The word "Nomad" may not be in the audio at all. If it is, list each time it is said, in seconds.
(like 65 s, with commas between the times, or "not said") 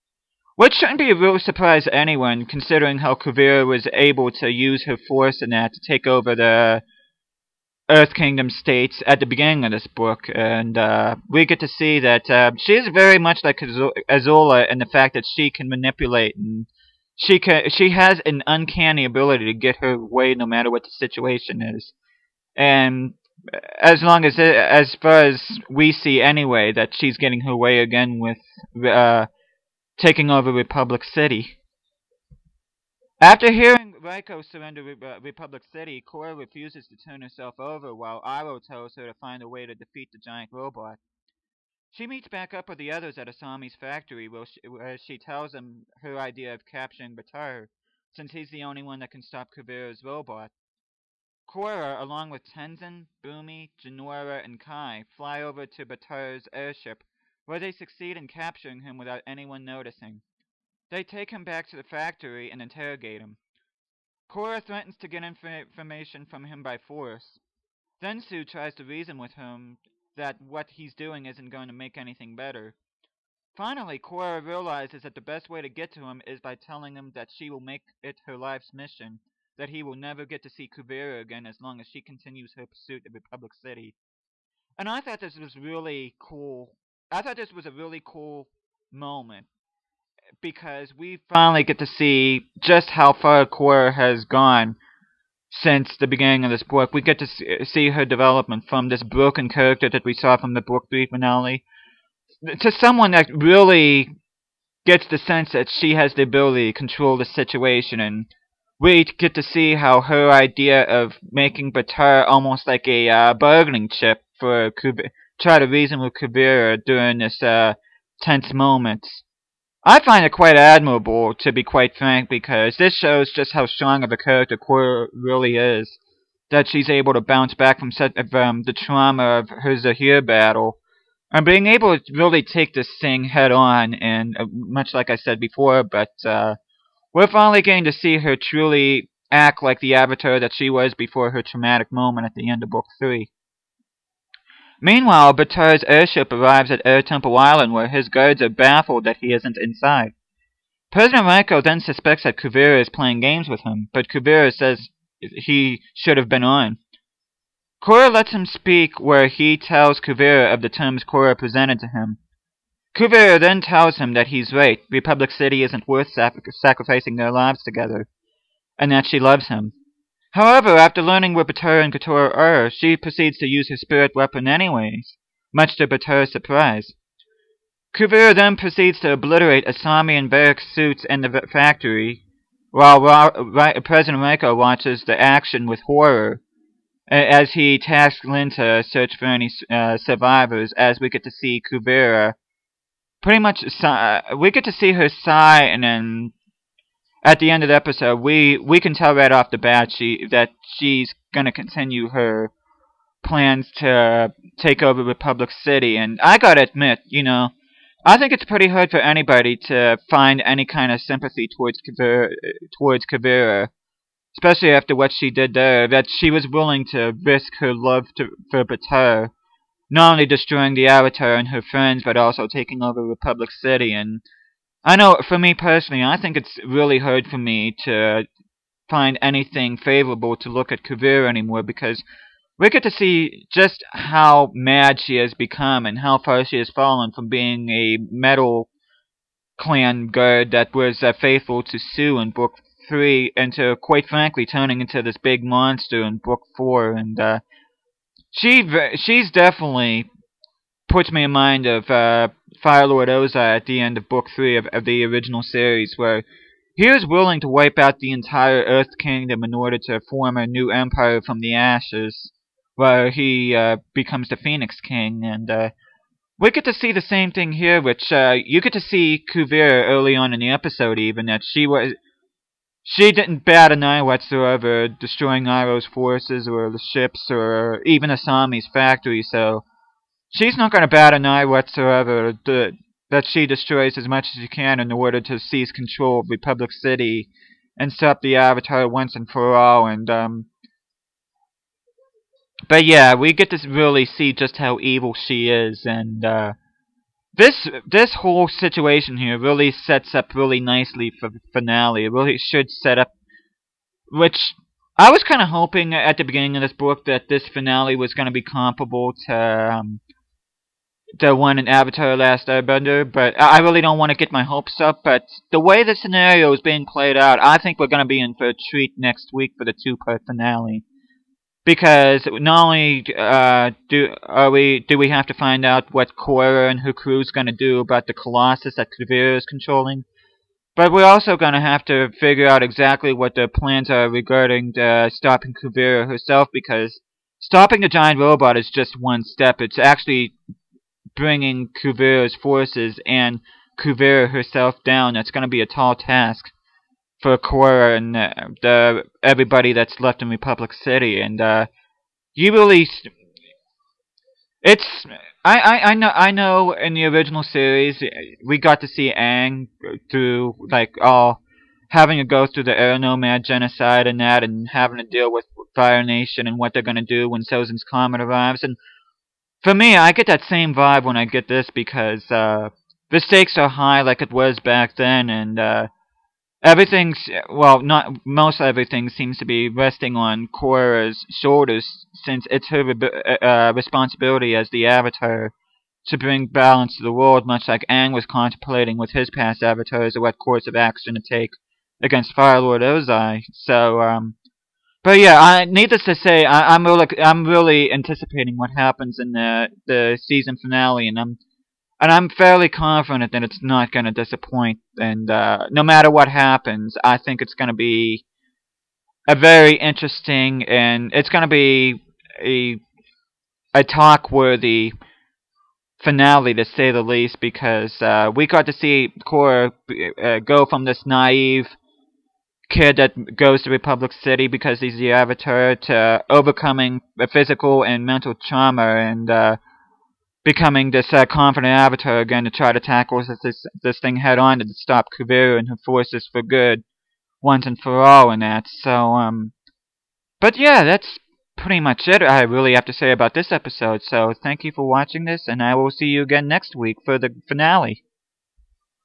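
362 s.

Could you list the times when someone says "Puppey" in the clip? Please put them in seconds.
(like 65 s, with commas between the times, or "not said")
not said.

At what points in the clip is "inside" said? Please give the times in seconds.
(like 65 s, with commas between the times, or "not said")
149 s.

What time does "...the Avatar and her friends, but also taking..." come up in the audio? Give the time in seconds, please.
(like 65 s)
220 s.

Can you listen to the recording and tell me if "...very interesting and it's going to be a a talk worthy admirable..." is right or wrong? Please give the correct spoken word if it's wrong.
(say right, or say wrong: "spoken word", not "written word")
wrong: "finale", not "admirable".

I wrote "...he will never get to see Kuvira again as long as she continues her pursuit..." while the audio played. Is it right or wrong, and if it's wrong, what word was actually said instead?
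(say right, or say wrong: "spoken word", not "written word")
right.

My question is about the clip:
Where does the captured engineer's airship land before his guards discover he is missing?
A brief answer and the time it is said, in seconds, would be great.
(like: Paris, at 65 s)
Air Temple Island, at 146 s.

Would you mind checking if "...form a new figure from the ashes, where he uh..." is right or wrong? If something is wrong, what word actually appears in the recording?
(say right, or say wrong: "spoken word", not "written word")
wrong: "empire", not "figure".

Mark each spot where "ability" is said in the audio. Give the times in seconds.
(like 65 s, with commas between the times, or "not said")
19 s, 106 s.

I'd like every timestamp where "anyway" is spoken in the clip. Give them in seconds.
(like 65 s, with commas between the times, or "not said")
26 s, 174 s.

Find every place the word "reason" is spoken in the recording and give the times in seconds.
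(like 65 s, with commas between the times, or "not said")
68 s, 115 s.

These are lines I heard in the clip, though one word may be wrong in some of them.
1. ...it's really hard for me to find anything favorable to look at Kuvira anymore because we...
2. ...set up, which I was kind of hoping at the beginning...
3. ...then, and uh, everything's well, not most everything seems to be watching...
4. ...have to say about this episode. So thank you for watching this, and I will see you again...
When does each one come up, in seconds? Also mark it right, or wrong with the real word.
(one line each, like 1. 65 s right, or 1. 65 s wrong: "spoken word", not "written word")
1. 226 s right
2. 302 s right
3. 374 s wrong: "resting", not "watching"
4. 442 s right.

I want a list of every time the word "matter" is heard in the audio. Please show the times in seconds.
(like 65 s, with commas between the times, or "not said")
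20 s, 405 s.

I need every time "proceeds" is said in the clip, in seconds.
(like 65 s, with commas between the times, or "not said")
172 s, 178 s.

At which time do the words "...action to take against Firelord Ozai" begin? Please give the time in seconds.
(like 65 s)
390 s.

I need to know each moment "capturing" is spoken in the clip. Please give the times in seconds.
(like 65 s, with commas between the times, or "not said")
46 s, 58 s.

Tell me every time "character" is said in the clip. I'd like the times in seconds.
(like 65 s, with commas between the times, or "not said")
99 s, 124 s.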